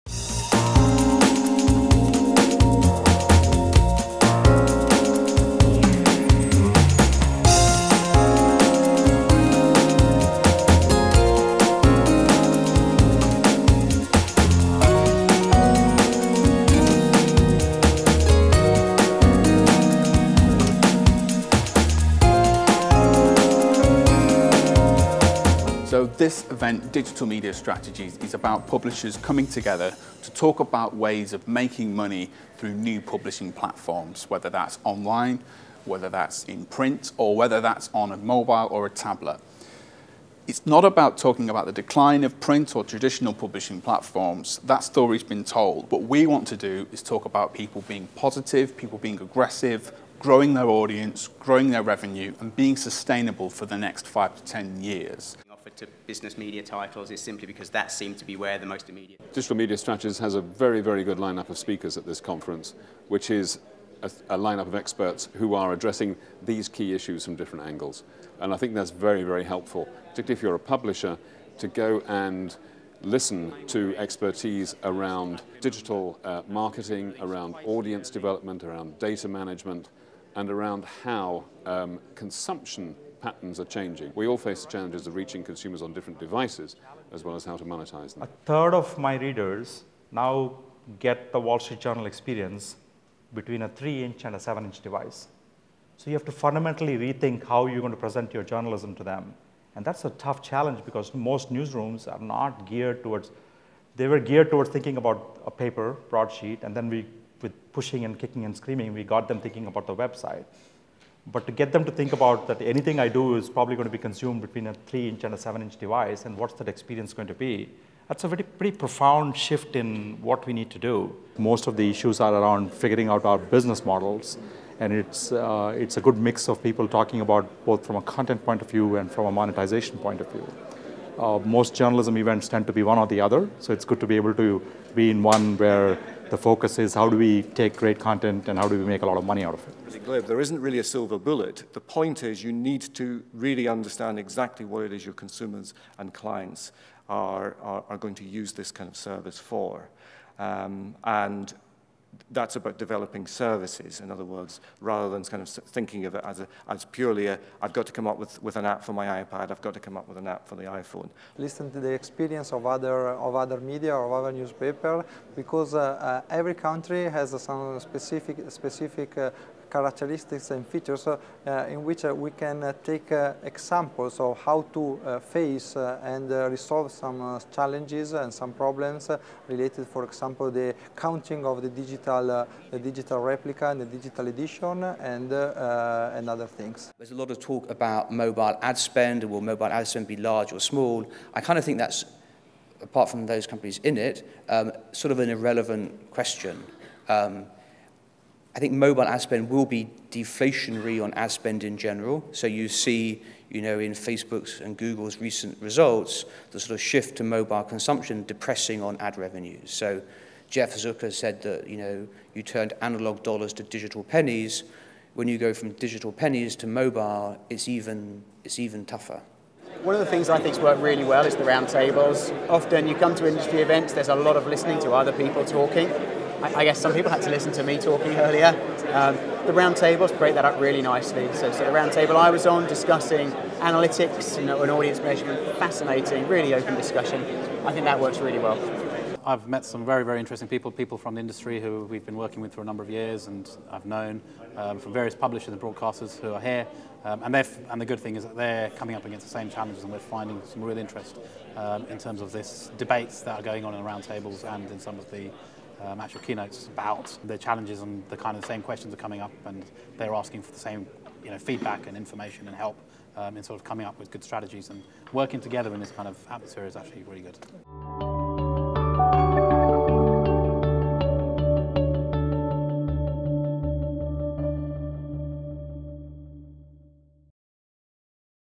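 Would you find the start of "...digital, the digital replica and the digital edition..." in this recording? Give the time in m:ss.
3:01.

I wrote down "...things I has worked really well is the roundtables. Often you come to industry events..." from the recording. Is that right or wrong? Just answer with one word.
right.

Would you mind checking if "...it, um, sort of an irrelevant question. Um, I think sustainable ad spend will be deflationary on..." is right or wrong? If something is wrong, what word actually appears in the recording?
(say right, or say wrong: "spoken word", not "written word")
wrong: "mobile", not "sustainable".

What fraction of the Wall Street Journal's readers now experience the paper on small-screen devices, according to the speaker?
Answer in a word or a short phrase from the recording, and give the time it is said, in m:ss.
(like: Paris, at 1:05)
A third, at 1:28.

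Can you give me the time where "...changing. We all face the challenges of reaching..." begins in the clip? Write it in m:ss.
1:23.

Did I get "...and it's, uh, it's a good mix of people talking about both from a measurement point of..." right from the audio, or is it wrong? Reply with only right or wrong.
wrong.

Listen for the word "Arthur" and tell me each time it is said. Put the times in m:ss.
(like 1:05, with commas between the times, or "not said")
not said.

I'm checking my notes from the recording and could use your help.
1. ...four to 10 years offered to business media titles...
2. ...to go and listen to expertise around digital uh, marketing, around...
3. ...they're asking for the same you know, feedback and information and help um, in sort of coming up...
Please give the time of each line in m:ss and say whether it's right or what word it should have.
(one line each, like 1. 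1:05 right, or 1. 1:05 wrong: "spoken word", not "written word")
1. 0:54 wrong: "five", not "four"
2. 1:11 right
3. 4:19 right.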